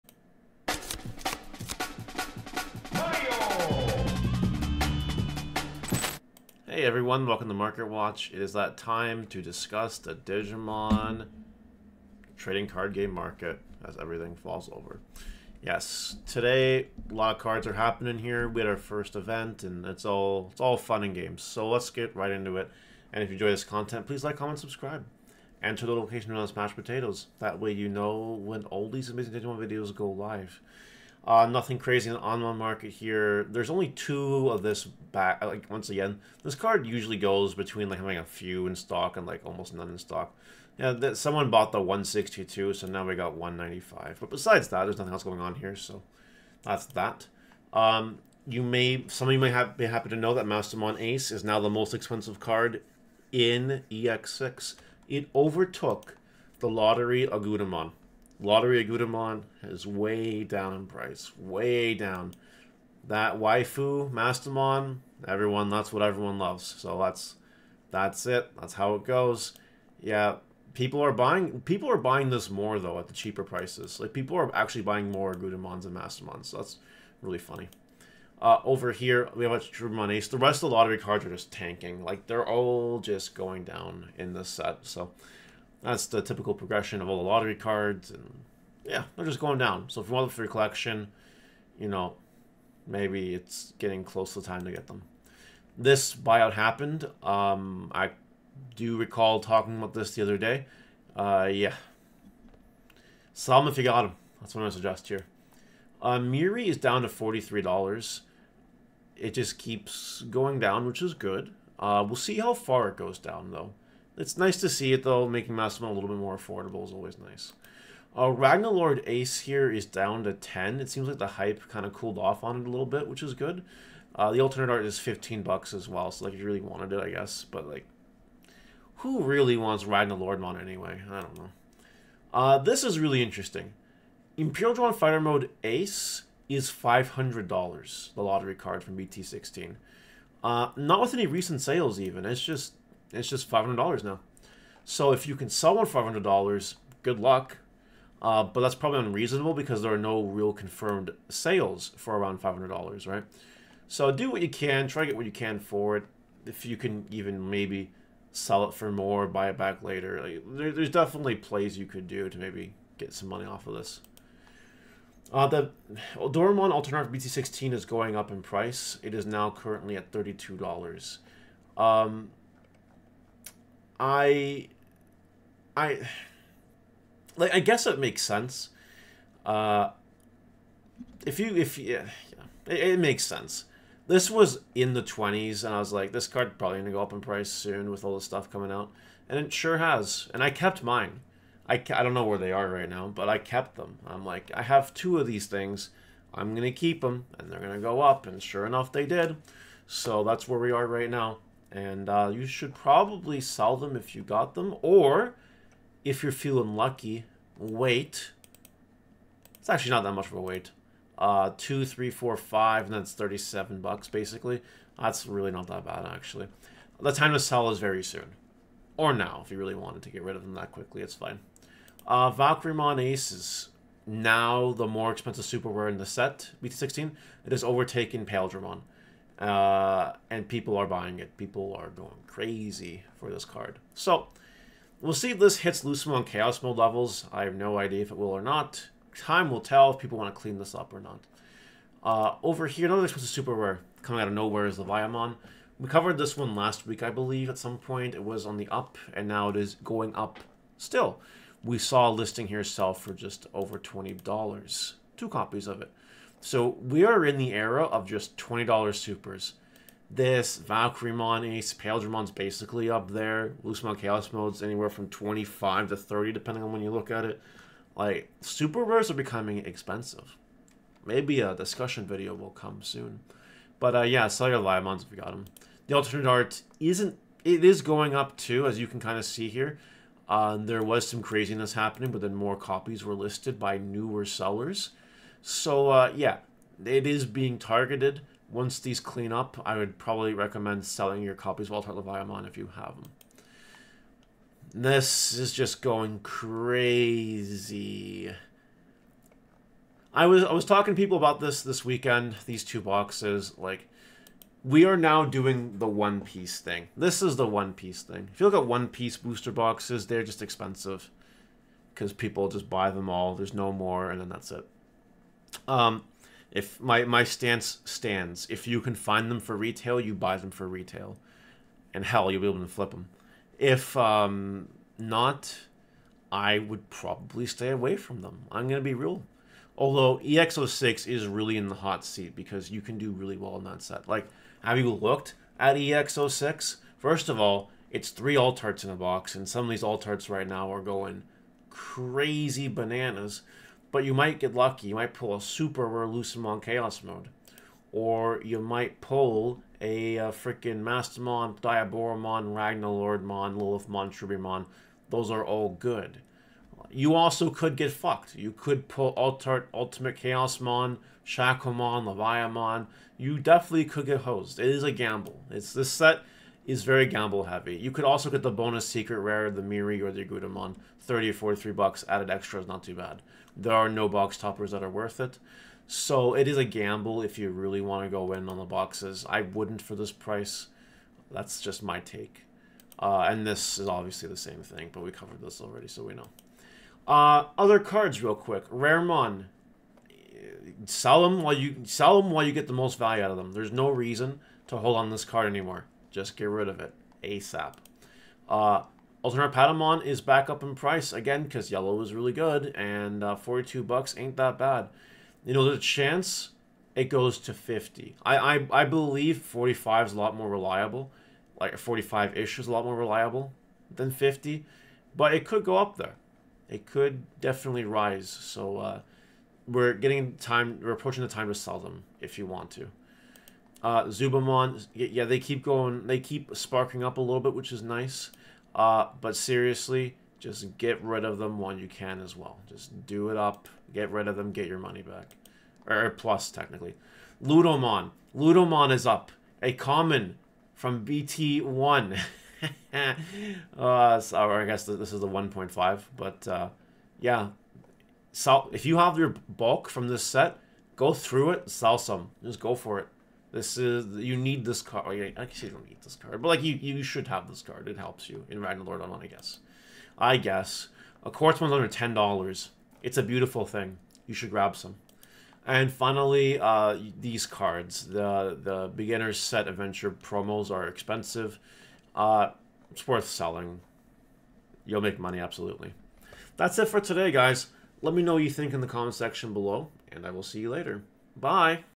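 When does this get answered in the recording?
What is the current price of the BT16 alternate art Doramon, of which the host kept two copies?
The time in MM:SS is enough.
02:50.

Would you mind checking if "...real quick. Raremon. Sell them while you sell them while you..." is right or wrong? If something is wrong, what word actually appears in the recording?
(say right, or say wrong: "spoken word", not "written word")
right.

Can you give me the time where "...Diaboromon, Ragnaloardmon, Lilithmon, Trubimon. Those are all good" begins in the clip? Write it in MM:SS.
05:51.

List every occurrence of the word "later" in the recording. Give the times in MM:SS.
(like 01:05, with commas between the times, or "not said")
02:39, 08:00.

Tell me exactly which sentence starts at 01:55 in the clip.
Making Massimo a little bit more affordable is always nice.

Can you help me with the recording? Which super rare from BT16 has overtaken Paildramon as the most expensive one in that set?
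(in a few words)
Valkyrimon Ace.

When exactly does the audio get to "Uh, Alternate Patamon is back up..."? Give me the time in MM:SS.
06:38.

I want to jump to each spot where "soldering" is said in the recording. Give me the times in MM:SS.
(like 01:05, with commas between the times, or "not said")
not said.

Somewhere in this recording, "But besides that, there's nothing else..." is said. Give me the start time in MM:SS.
00:44.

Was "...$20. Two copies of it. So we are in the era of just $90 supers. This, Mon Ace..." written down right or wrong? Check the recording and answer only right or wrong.
wrong.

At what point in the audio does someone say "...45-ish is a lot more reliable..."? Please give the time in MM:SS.
06:51.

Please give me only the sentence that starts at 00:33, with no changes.
There's only two of this back.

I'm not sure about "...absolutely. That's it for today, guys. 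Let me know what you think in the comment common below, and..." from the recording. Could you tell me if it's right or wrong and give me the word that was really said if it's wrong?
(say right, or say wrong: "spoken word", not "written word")
wrong: "section", not "common".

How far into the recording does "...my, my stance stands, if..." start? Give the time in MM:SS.
05:16.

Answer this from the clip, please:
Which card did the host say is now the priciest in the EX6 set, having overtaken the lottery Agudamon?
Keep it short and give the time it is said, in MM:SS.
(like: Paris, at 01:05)
Mastemon Ace, at 00:50.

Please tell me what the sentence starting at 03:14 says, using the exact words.
I'm like, I have two of these things.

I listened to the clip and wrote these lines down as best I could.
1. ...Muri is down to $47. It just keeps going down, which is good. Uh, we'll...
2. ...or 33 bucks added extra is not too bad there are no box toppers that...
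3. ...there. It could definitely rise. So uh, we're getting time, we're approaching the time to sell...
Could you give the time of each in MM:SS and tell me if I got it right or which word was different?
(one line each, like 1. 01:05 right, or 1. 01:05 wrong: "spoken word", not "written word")
1. 01:46 wrong: "43", not "47"
2. 06:11 wrong: "43", not "33"
3. 06:55 right.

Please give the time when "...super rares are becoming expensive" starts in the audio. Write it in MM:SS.
04:28.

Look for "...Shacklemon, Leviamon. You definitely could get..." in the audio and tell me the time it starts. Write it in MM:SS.
06:01.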